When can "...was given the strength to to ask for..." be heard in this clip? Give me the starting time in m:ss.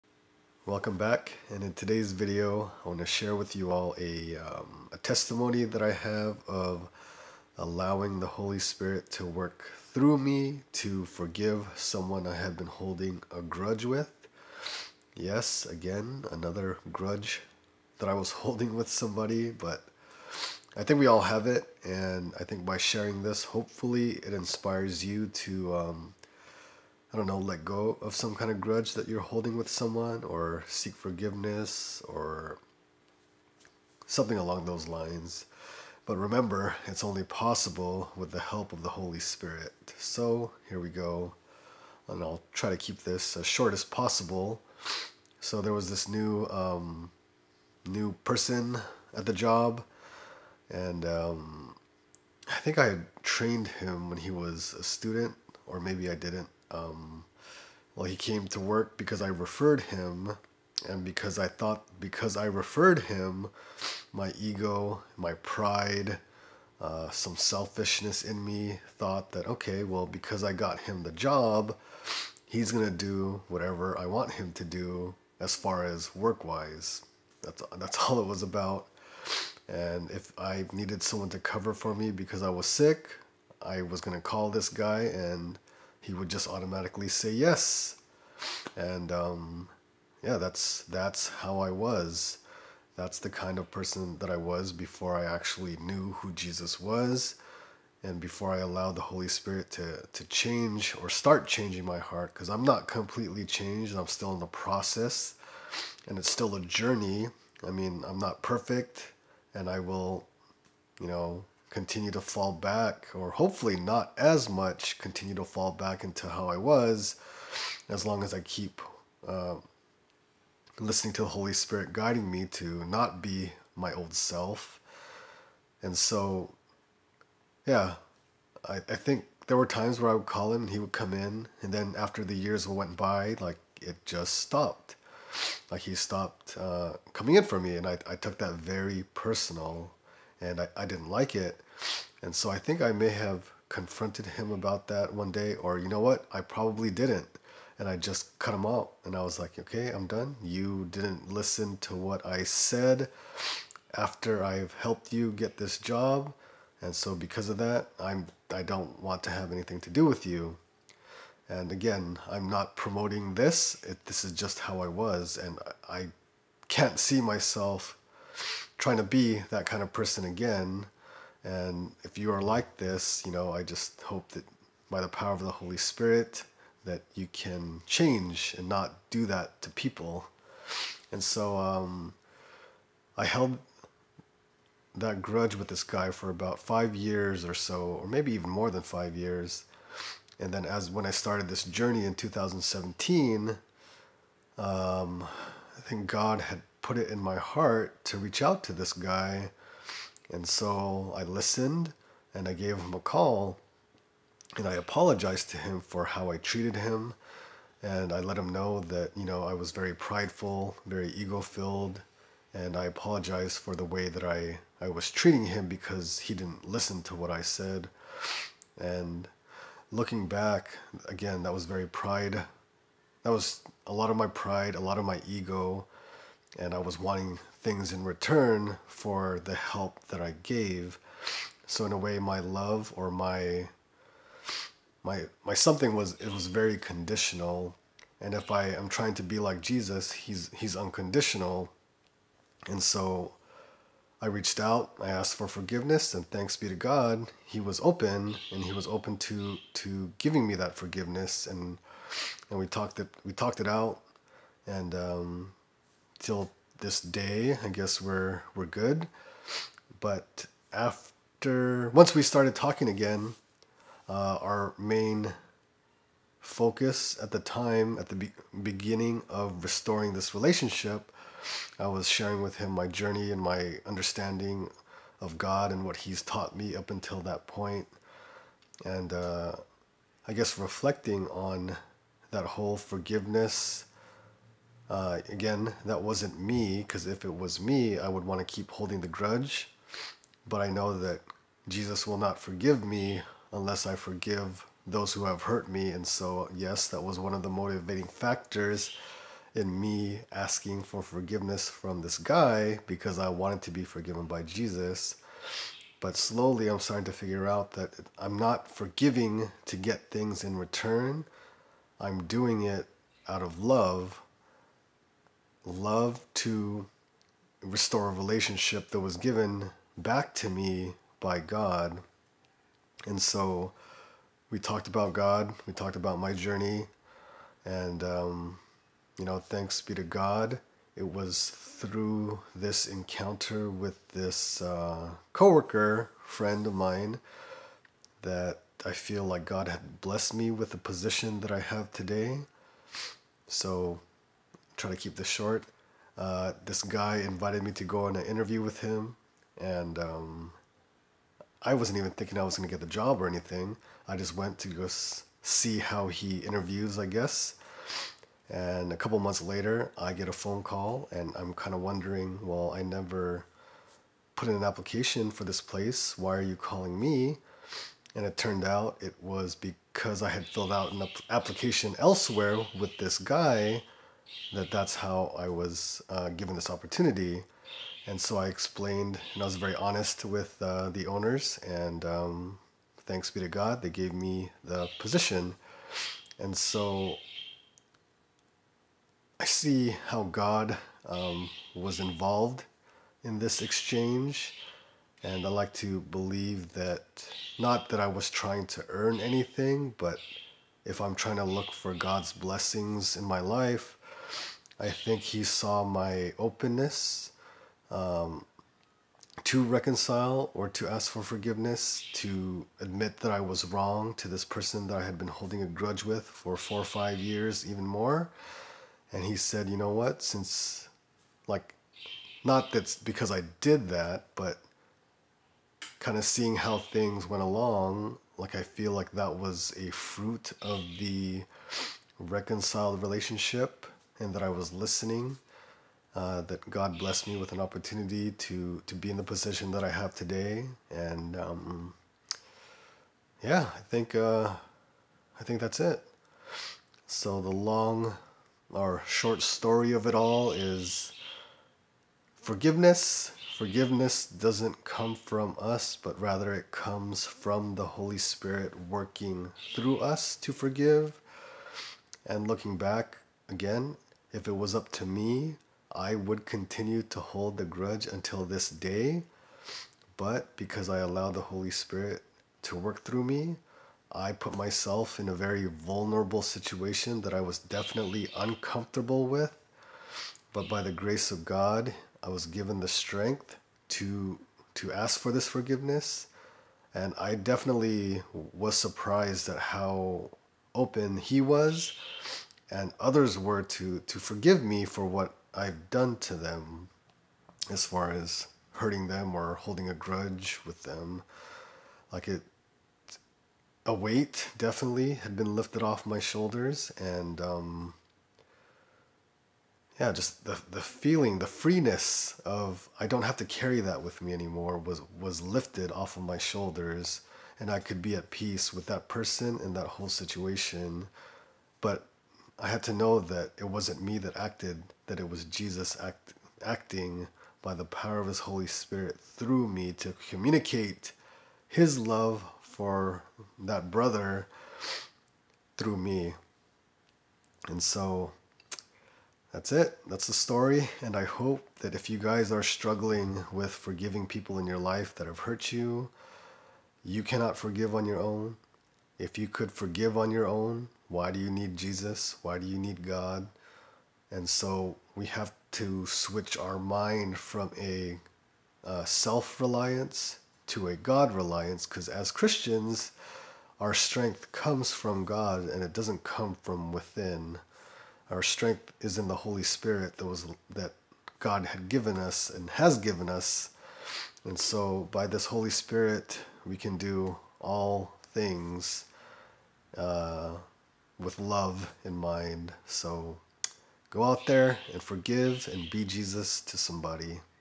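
8:02.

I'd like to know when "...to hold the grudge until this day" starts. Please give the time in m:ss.
7:47.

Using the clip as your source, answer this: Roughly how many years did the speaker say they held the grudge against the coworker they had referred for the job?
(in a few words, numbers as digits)
5.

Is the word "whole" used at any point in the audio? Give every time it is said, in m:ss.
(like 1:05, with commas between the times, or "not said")
4:42, 8:39.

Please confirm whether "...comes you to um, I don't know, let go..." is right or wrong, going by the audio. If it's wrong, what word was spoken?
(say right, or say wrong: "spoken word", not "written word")
wrong: "inspires", not "comes".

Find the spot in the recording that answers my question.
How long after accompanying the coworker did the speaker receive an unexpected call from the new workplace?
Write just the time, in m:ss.
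5:58.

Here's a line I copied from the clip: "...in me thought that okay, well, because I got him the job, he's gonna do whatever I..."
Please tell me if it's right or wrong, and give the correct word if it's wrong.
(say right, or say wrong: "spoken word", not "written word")
right.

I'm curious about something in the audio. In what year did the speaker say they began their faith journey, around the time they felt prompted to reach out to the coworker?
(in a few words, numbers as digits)
2017.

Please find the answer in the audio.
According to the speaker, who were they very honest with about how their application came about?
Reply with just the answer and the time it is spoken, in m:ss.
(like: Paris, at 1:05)
The owners, at 6:20.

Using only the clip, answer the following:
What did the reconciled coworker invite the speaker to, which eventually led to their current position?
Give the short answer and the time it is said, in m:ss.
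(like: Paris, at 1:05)
An interview, at 5:48.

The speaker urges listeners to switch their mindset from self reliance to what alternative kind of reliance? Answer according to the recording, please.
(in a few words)
God reliance.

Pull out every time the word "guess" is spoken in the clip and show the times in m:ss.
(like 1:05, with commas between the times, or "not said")
4:17, 4:40, 5:57.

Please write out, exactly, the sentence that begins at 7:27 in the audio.
So the long or short story of it all is forgiveness.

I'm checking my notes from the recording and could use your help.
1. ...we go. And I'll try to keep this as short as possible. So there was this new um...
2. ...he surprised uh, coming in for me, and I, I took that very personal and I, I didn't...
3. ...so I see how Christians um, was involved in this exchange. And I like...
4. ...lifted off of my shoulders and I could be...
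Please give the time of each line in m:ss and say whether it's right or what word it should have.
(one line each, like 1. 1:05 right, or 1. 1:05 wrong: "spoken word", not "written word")
1. 0:40 right
2. 2:15 wrong: "stopped", not "surprised"
3. 6:26 wrong: "God", not "Christians"
4. 8:35 right.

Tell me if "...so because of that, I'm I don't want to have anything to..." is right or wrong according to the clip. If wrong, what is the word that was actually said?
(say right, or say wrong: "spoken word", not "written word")
right.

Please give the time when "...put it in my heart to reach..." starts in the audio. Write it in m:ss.
3:16.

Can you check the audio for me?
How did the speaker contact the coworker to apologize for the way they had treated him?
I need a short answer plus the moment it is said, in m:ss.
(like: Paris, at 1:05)
A phone call, at 3:22.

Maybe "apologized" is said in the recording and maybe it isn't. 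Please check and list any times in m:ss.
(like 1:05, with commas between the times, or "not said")
3:24, 3:32.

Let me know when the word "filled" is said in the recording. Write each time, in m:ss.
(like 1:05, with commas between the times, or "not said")
3:31, 6:10.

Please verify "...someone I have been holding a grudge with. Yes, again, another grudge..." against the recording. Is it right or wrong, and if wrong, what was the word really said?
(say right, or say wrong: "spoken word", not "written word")
right.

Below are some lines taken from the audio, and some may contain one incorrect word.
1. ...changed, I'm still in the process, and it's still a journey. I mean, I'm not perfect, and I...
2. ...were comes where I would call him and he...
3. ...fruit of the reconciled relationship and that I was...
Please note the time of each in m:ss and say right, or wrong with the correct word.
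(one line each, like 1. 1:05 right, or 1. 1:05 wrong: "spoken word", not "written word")
1. 1:43 right
2. 2:09 wrong: "times", not "comes"
3. 7:09 right.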